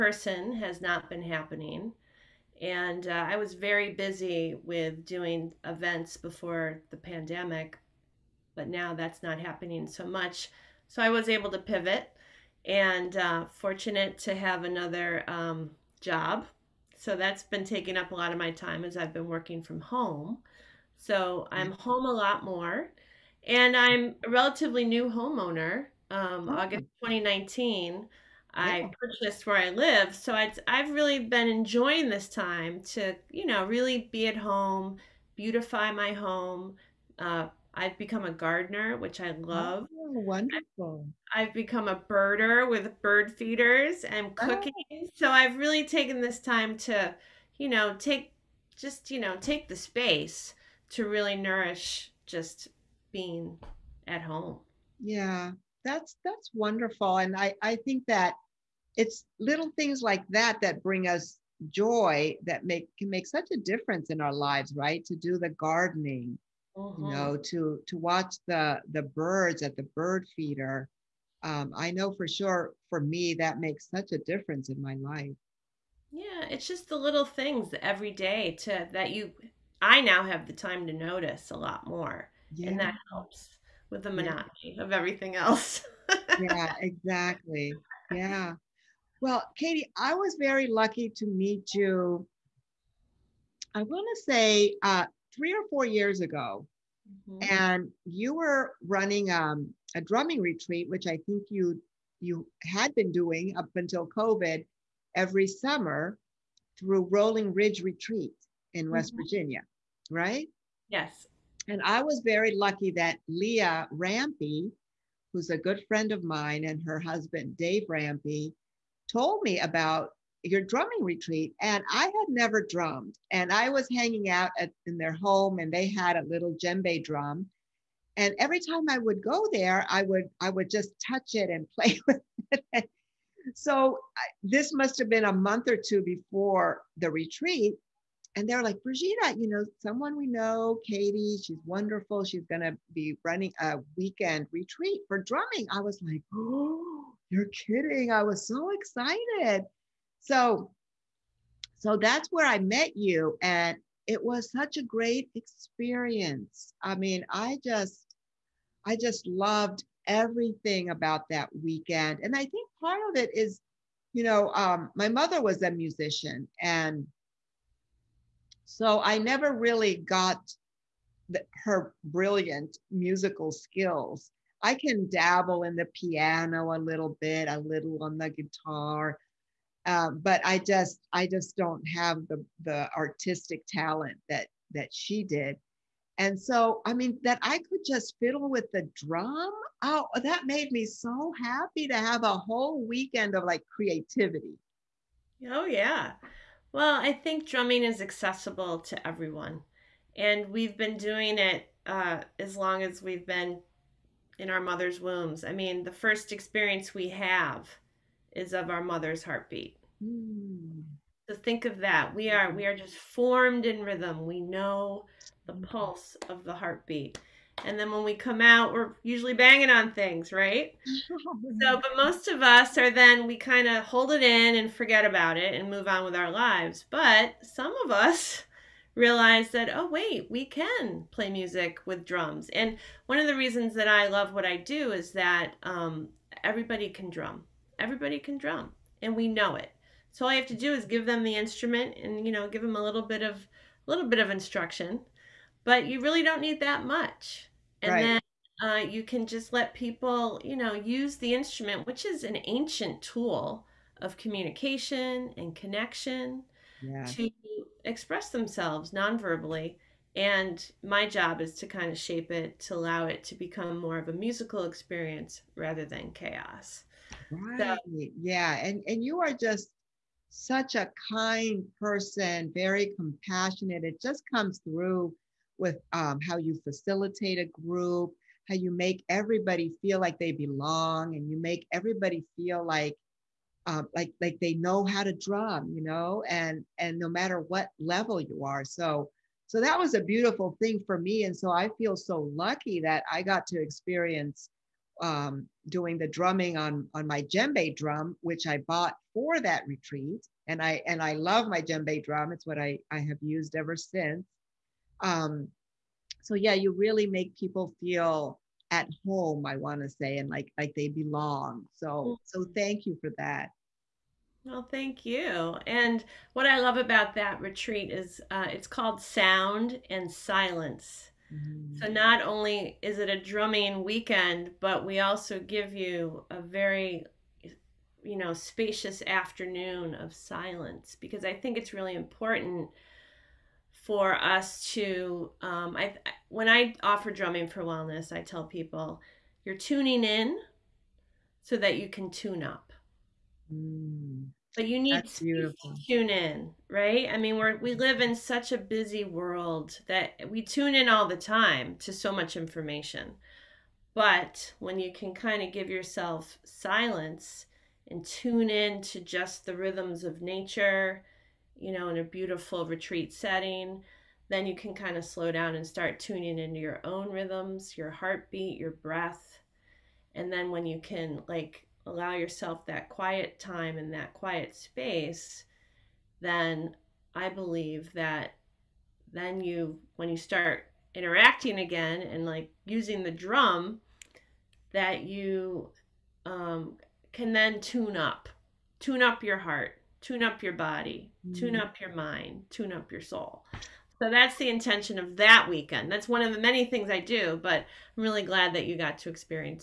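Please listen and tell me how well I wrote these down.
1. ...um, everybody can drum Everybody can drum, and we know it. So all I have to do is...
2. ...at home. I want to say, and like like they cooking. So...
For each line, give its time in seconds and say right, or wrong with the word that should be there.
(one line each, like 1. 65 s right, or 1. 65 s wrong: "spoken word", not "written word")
1. 235 s right
2. 308 s wrong: "belong", not "cooking".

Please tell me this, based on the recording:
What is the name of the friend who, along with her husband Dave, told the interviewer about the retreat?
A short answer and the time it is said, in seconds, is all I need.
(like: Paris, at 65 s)
Leah Rampy, at 113 s.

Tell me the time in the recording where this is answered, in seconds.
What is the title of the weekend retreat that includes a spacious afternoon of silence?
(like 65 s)
319 s.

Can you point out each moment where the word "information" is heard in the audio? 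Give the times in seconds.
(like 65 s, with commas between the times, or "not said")
352 s.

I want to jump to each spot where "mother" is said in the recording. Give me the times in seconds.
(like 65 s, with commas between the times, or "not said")
165 s, 204 s, 208 s.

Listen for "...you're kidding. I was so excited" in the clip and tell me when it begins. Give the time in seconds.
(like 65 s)
147 s.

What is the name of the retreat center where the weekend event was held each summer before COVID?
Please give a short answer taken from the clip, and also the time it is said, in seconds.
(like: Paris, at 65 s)
Rolling Ridge Retreat, at 107 s.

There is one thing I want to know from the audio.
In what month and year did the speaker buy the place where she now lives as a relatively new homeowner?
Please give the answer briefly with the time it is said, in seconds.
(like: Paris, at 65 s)
August 2019, at 26 s.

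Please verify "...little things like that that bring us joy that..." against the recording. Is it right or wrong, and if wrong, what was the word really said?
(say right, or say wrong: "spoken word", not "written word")
right.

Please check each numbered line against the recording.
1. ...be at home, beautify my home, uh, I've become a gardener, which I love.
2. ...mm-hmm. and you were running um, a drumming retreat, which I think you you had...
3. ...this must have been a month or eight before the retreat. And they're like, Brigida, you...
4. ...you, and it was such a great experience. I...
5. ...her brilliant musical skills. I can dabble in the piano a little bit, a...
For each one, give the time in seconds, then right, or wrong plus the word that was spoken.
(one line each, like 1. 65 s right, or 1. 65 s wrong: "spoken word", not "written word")
1. 34 s right
2. 97 s right
3. 134 s wrong: "two", not "eight"
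4. 152 s right
5. 171 s right.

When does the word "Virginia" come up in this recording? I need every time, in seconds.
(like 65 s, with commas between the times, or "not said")
109 s.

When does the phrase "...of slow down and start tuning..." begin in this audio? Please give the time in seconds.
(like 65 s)
364 s.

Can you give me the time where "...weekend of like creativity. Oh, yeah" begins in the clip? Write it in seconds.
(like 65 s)
192 s.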